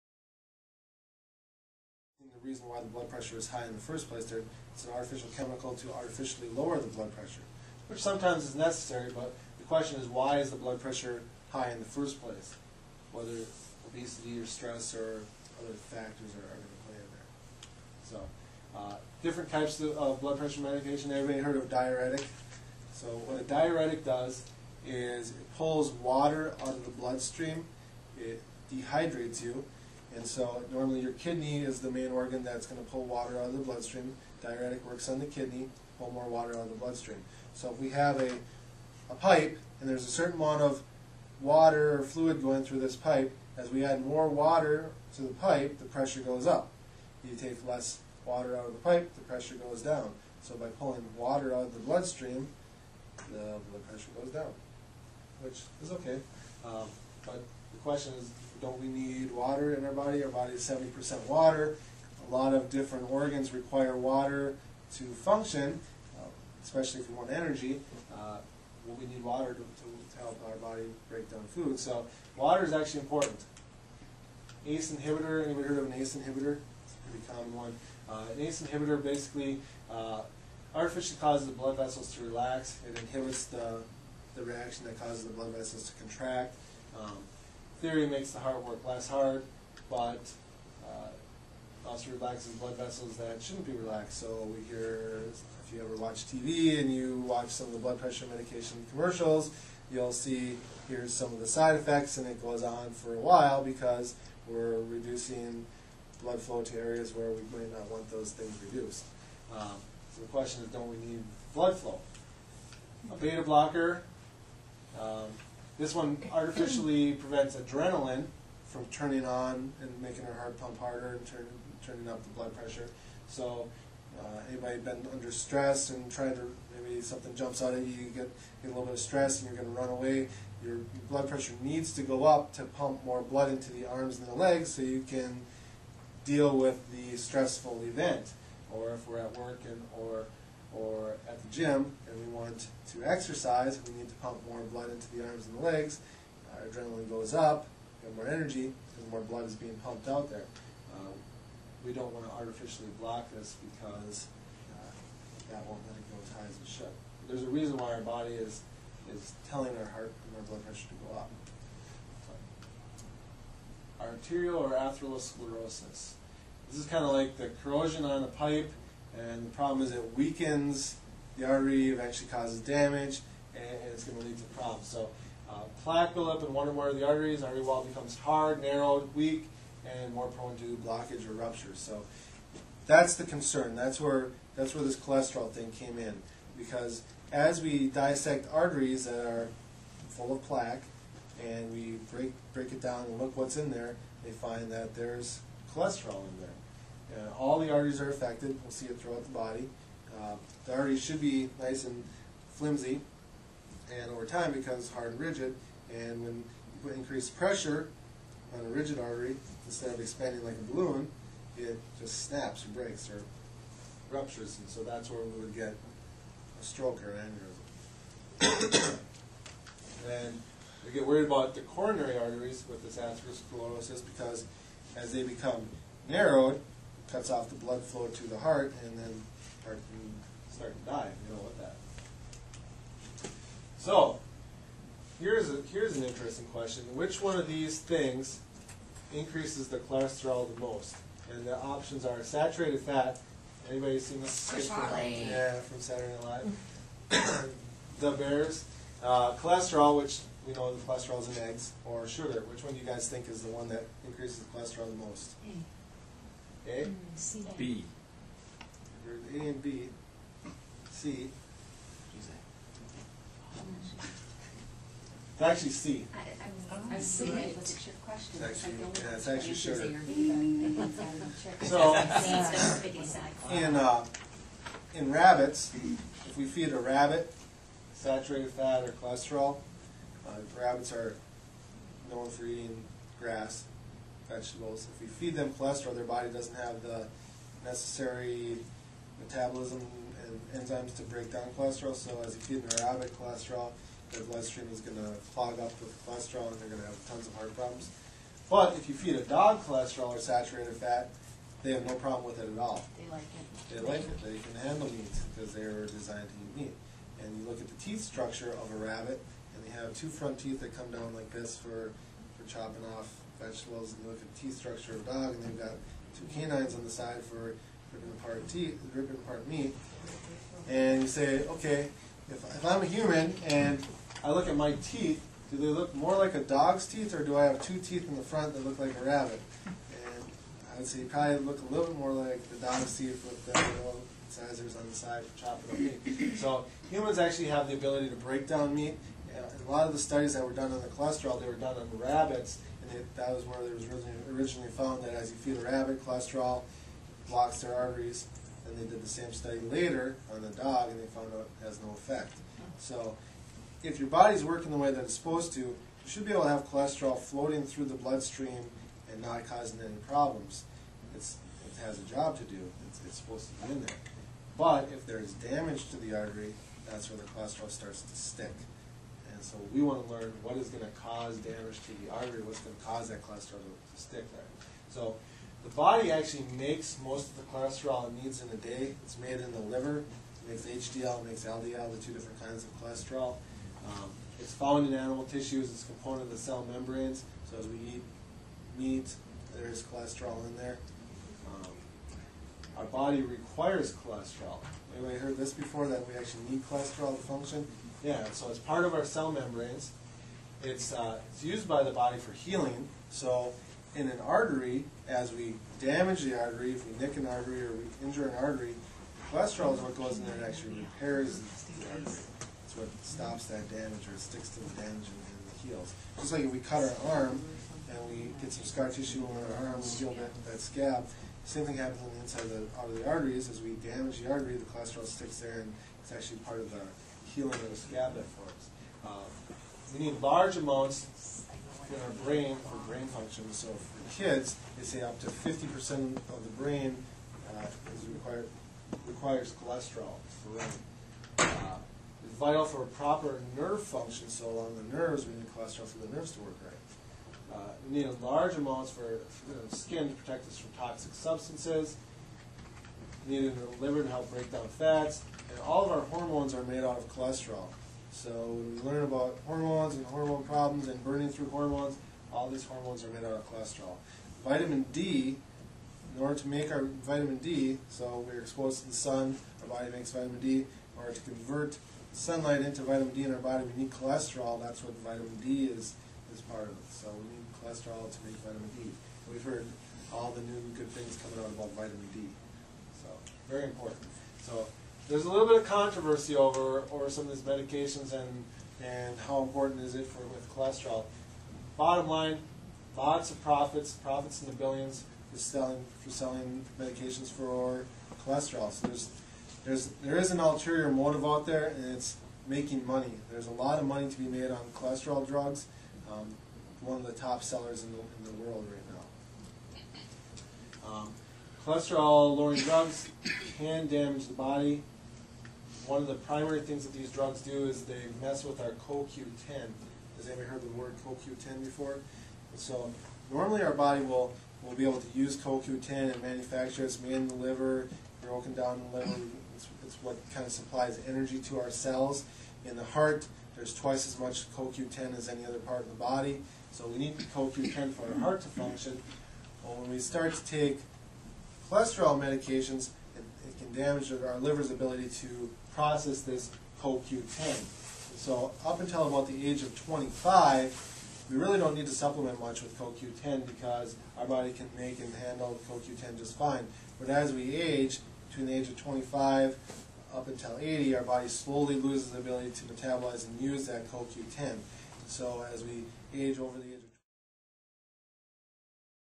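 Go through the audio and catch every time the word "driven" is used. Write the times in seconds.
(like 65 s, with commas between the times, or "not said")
not said.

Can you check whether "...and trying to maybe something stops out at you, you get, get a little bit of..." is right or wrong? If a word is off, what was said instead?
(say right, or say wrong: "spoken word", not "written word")
wrong: "jumps", not "stops".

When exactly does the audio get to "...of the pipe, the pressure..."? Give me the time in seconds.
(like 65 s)
48 s.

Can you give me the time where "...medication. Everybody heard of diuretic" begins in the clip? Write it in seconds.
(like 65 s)
20 s.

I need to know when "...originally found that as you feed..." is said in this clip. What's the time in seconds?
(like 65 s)
344 s.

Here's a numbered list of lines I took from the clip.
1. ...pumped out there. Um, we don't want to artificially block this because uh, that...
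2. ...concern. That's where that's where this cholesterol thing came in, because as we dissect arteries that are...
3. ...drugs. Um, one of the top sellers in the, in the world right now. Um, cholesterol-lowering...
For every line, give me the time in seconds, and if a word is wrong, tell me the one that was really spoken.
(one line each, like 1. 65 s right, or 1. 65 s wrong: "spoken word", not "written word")
1. 149 s right
2. 183 s right
3. 505 s right.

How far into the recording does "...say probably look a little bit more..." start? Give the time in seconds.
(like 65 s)
330 s.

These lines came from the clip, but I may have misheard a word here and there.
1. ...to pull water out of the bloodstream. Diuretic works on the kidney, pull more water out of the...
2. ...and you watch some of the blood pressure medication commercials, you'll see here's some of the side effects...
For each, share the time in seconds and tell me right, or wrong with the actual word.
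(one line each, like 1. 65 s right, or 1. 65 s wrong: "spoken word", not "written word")
1. 32 s right
2. 96 s right.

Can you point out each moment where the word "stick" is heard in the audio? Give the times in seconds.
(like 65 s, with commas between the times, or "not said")
368 s, 374 s, 414 s, 425 s.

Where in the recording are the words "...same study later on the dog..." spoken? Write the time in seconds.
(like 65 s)
349 s.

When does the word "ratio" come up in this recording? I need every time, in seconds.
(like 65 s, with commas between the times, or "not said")
not said.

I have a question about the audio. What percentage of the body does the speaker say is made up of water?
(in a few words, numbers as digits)
70%.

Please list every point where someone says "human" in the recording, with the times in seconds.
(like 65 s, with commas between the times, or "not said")
322 s, 336 s.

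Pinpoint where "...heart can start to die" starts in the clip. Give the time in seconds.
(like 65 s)
229 s.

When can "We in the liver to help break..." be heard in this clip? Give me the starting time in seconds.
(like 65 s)
453 s.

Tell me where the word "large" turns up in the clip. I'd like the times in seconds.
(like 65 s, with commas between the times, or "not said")
430 s, 448 s.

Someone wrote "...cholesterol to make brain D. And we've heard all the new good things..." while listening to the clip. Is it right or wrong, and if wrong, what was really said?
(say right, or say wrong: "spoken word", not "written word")
wrong: "vitamin", not "brain".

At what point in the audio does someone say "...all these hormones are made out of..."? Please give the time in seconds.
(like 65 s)
462 s.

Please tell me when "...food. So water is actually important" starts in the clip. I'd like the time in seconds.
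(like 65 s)
71 s.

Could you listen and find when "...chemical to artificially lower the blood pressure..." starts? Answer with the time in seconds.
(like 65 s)
5 s.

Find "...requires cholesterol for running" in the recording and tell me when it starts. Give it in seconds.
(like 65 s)
439 s.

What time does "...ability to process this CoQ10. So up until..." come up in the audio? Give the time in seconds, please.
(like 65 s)
544 s.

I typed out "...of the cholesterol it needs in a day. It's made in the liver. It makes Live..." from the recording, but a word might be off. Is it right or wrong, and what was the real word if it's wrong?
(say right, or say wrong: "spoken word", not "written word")
wrong: "HDL", not "Live".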